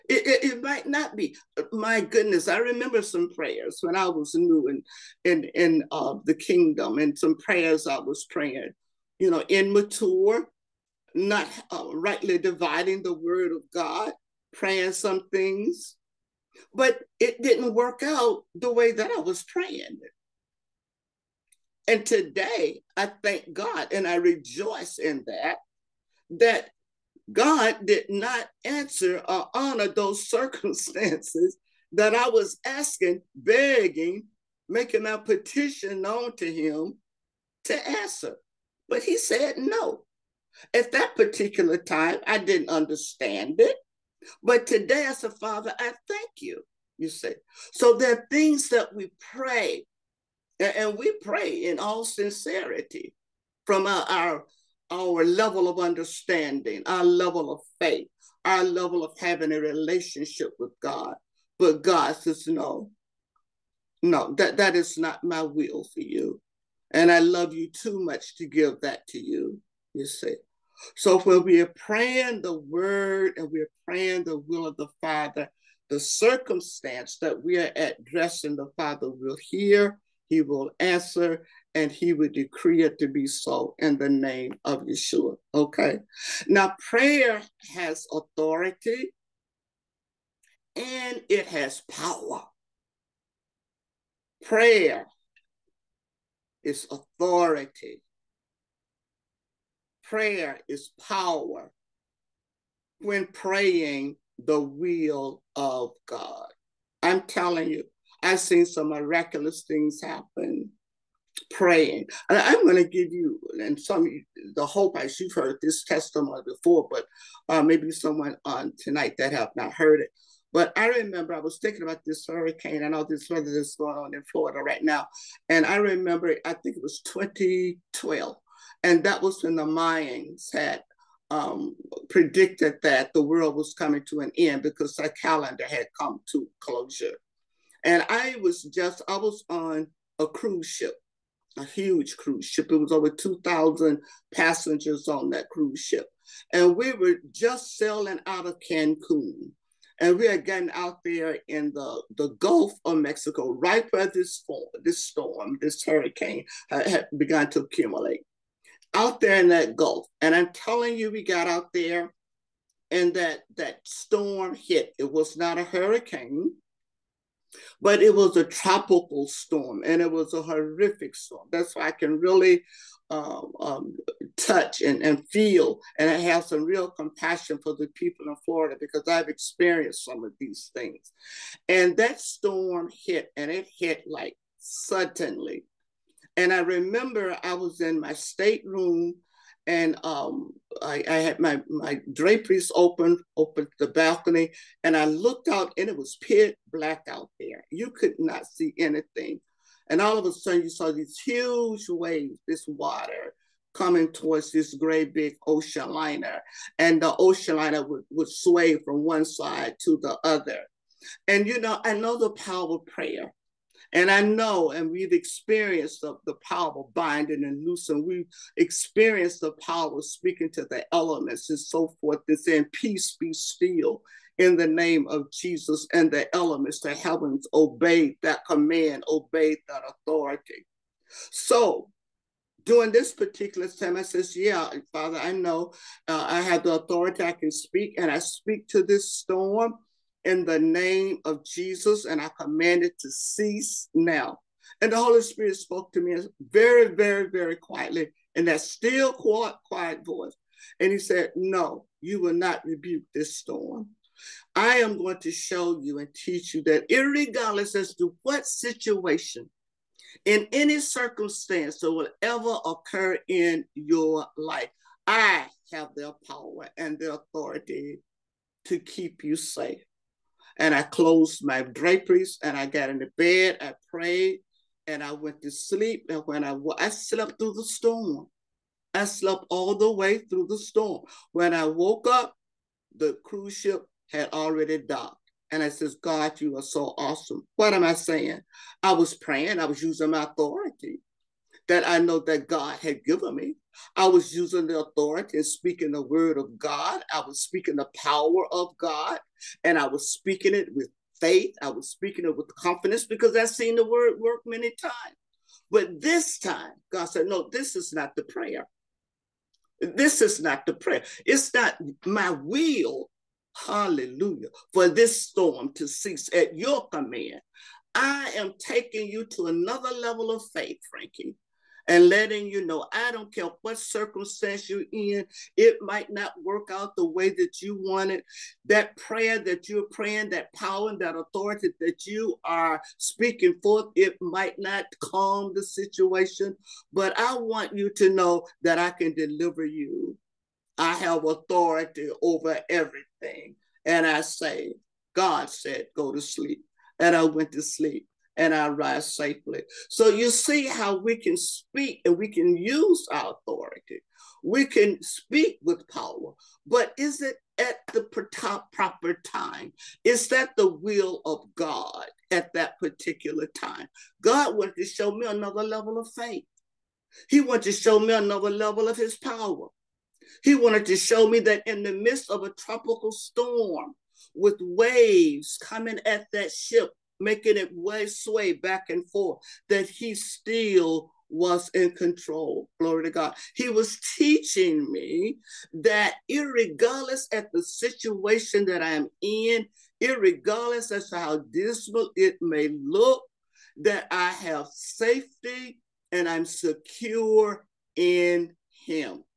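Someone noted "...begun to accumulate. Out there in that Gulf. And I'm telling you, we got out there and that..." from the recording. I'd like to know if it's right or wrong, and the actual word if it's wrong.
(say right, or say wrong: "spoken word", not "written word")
right.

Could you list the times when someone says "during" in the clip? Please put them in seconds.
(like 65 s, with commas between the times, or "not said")
232 s.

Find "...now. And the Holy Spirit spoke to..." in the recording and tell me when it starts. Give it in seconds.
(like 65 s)
243 s.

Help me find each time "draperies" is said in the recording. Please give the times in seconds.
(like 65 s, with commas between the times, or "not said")
192 s, 271 s.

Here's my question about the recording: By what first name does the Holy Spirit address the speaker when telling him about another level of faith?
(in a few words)
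Frankie.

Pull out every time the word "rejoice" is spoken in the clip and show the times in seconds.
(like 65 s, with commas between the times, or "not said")
24 s.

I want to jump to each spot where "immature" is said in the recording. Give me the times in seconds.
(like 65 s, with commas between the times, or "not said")
9 s.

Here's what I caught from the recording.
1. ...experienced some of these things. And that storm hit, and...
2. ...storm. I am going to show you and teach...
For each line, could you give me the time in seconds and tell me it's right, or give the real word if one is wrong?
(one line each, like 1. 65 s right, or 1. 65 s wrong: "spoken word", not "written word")
1. 179 s right
2. 253 s right.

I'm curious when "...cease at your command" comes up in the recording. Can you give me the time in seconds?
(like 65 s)
315 s.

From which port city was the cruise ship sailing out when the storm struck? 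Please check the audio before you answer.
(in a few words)
Cancun.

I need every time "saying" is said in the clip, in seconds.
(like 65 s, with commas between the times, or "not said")
222 s, 287 s.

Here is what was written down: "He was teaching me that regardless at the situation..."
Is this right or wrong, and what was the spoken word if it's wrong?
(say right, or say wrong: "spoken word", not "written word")
right.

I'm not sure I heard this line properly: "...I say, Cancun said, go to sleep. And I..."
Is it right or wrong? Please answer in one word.
wrong.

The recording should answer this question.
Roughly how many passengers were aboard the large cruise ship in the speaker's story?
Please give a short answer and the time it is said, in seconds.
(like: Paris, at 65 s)
Over 2,000, at 142 s.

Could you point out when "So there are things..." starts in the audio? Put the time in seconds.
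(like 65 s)
47 s.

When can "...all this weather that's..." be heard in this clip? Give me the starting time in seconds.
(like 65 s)
122 s.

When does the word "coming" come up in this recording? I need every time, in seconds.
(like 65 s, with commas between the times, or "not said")
133 s, 203 s, 375 s.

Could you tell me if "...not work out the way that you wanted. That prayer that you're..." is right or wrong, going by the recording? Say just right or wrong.
right.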